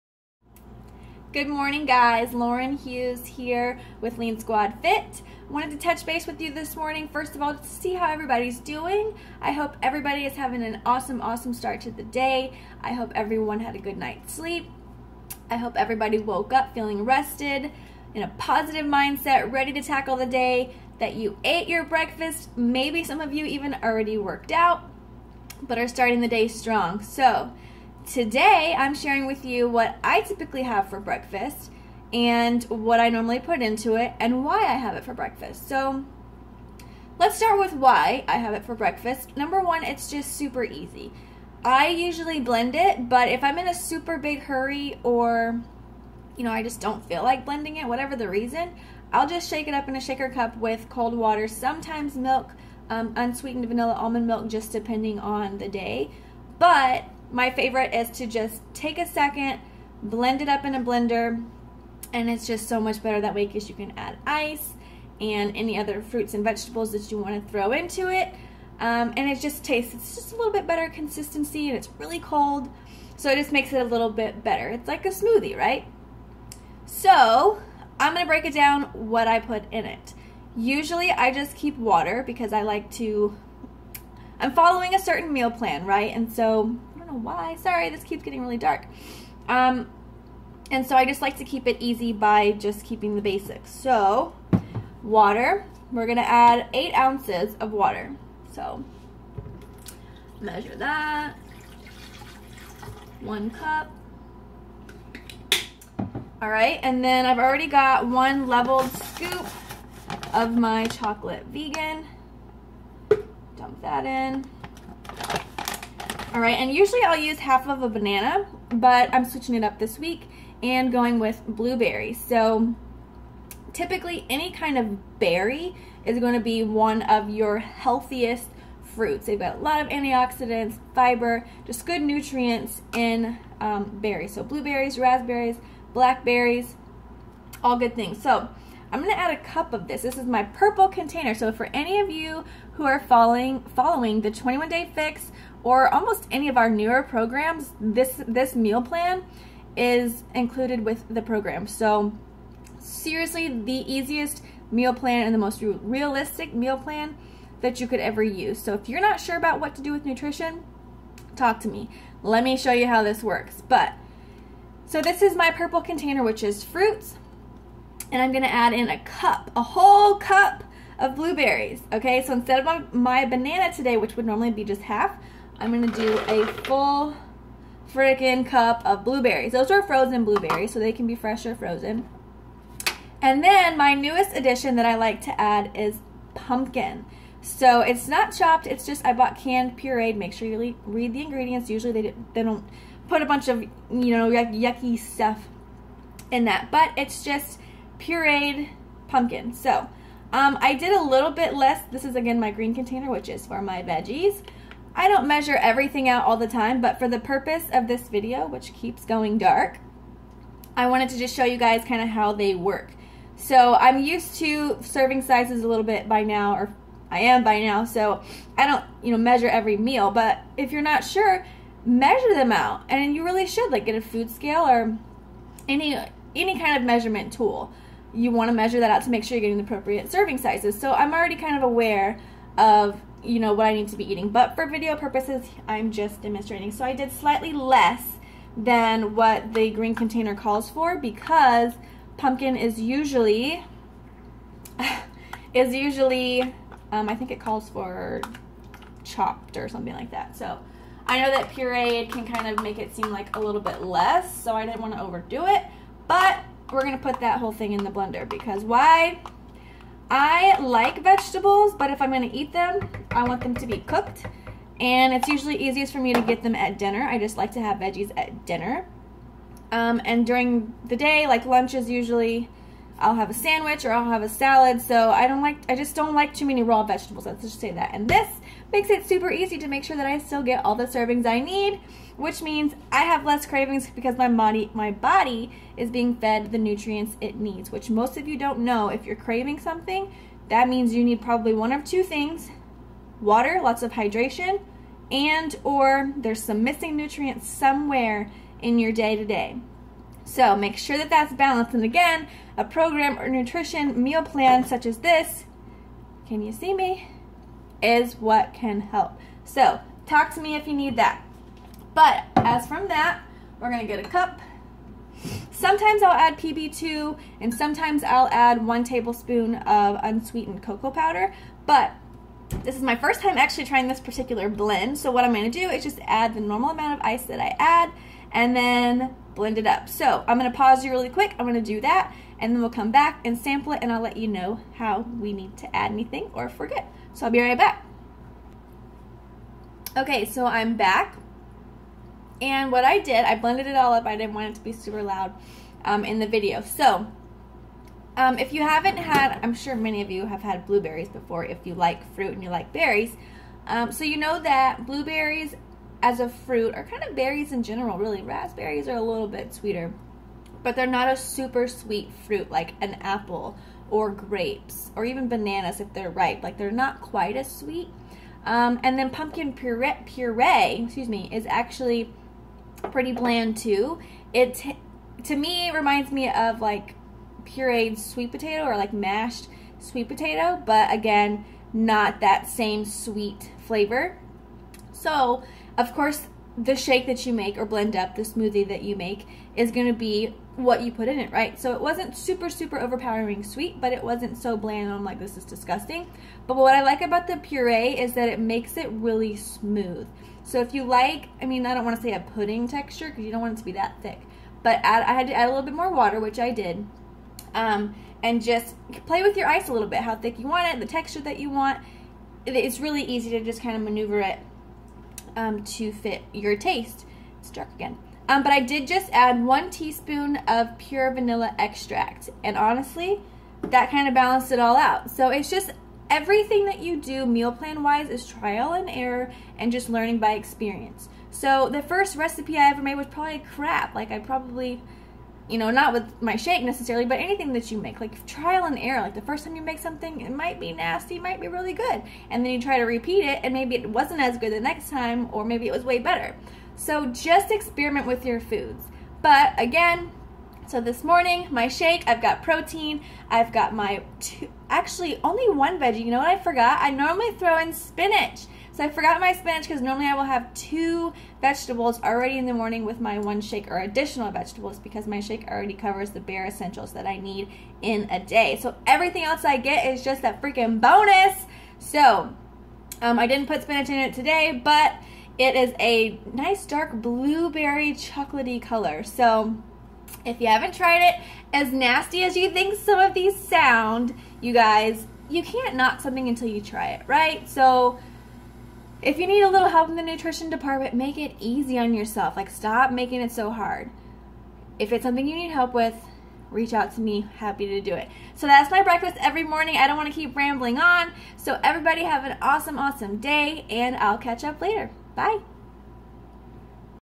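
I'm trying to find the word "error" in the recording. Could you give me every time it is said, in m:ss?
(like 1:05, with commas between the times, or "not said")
7:08, 7:18.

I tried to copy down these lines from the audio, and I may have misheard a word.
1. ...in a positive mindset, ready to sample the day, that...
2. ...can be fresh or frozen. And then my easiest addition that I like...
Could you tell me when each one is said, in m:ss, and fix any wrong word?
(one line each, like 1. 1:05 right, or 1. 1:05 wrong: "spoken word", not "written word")
1. 0:18 wrong: "tackle", not "sample"
2. 3:00 wrong: "newest", not "easiest".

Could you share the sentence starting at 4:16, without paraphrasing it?
But we're gonna put that whole thing in the blender because why?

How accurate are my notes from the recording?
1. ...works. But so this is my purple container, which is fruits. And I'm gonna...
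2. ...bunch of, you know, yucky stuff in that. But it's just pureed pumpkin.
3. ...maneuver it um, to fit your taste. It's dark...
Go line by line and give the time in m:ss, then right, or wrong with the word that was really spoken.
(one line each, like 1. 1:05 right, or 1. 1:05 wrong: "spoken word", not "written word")
1. 2:43 right
2. 3:13 right
3. 6:53 right.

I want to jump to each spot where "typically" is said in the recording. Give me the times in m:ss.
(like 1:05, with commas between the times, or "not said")
0:30, 2:03.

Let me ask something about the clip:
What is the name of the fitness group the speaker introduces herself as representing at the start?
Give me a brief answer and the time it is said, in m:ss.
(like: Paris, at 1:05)
Lean Squad Fit, at 0:04.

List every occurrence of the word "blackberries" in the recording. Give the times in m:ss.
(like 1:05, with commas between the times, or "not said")
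2:15.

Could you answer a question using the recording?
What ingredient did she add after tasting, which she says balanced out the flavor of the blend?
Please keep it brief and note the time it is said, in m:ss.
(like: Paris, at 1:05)
pure vanilla extract, at 7:00.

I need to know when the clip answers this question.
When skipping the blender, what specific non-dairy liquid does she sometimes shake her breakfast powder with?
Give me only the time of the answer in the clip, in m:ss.
0:53.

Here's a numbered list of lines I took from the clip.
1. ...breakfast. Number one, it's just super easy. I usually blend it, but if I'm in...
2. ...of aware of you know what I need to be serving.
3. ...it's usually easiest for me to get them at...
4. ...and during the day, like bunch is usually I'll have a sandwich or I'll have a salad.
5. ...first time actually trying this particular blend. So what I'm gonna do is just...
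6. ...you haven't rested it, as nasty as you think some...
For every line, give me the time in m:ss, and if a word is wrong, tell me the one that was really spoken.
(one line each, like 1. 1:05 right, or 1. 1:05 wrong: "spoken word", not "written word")
1. 0:38 right
2. 3:51 wrong: "eating", not "serving"
3. 4:25 right
4. 4:30 wrong: "lunch", not "bunch"
5. 5:22 right
6. 8:00 wrong: "tried", not "rested".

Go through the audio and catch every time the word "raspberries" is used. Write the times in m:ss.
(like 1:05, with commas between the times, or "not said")
2:14, 5:58.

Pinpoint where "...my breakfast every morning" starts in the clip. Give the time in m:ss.
8:18.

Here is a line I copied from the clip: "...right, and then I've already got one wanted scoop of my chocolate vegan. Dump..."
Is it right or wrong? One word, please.
wrong.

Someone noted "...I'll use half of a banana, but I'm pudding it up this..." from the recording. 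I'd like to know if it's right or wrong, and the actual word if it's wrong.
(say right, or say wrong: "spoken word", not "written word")
wrong: "switching", not "pudding".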